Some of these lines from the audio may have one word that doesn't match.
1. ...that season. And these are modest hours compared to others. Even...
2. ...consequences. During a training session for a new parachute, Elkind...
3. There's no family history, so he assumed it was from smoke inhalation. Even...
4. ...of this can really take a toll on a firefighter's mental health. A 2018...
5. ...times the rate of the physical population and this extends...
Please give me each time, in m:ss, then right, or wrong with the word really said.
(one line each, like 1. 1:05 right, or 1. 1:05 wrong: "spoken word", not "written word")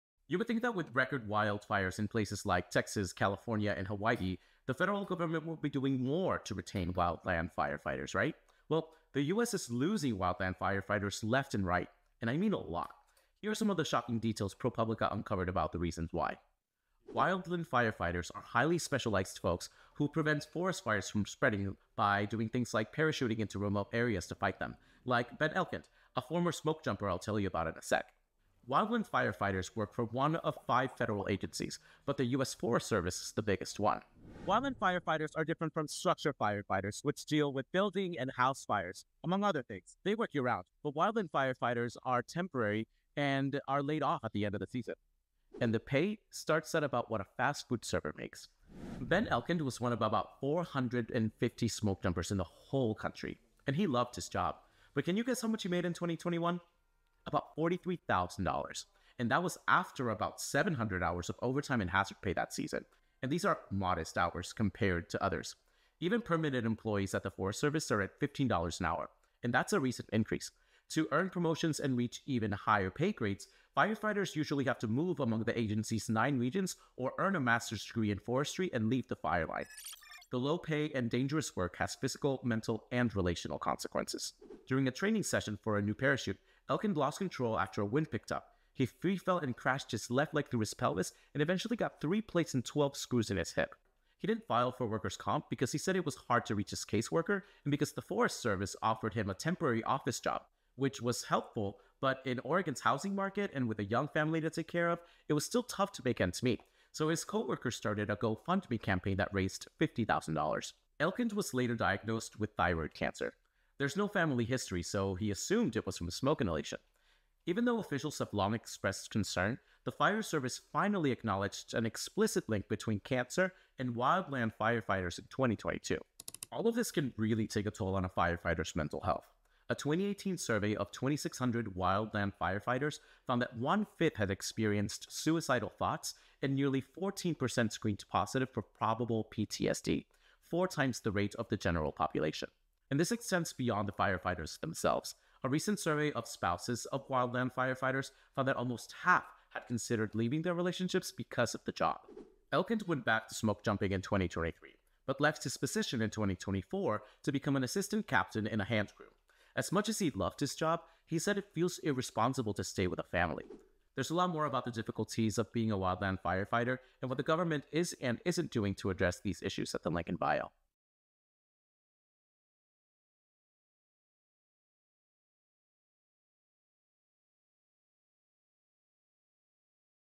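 1. 1:02 right
2. 1:23 right
3. 1:53 right
4. 2:06 right
5. 2:20 wrong: "general", not "physical".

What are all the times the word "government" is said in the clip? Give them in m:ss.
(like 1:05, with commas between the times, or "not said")
0:05, 2:47.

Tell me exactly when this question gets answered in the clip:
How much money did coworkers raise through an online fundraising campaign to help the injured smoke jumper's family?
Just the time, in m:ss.
1:49.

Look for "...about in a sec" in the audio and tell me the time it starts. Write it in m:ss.
0:27.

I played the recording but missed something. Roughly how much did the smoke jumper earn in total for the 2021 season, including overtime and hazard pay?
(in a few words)
$43,000.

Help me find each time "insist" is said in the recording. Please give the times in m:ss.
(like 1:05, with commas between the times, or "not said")
not said.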